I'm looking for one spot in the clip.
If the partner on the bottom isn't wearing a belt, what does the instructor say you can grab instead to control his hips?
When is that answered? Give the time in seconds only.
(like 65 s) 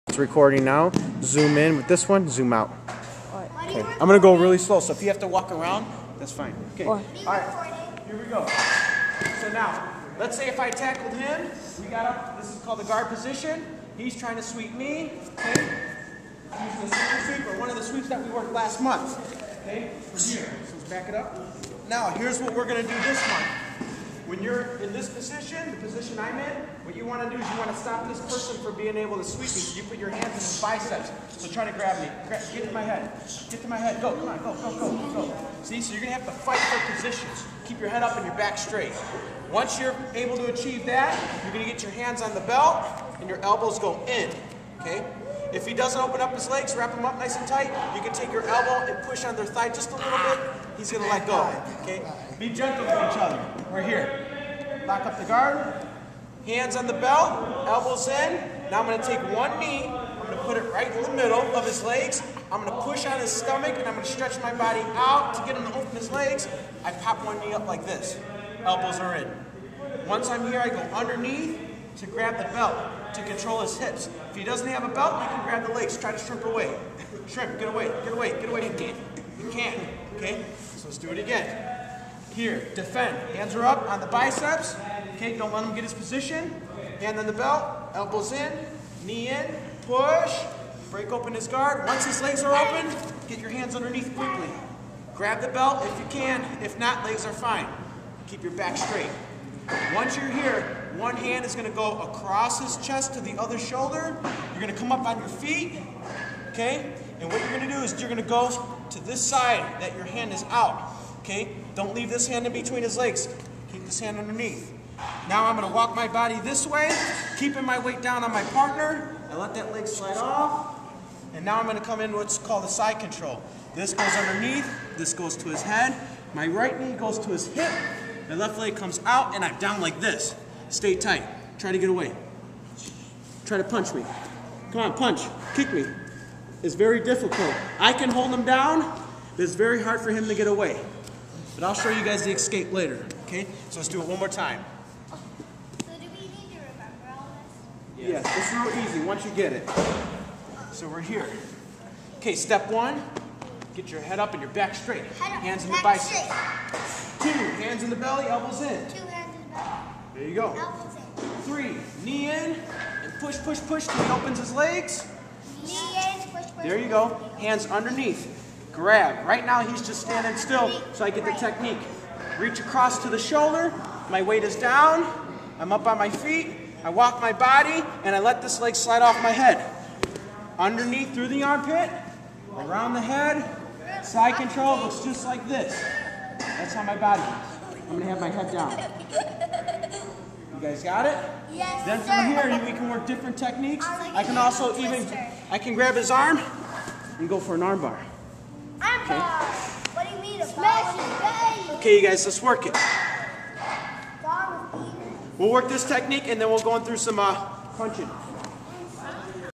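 75 s.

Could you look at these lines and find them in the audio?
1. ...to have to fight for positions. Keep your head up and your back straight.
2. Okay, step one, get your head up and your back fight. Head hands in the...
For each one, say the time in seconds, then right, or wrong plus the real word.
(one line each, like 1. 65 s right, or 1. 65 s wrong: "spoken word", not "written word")
1. 36 s right
2. 152 s wrong: "straight", not "fight".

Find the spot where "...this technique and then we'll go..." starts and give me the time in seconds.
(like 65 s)
205 s.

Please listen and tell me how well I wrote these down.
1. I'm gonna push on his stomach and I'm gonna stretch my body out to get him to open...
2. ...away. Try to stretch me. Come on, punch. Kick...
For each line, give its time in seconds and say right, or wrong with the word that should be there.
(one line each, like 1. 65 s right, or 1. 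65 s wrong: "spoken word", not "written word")
1. 62 s right
2. 131 s wrong: "punch", not "stretch".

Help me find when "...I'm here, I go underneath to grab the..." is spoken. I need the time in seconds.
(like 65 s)
70 s.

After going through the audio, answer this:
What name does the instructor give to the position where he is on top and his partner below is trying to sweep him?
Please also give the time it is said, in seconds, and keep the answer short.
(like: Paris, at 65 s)
guard position, at 12 s.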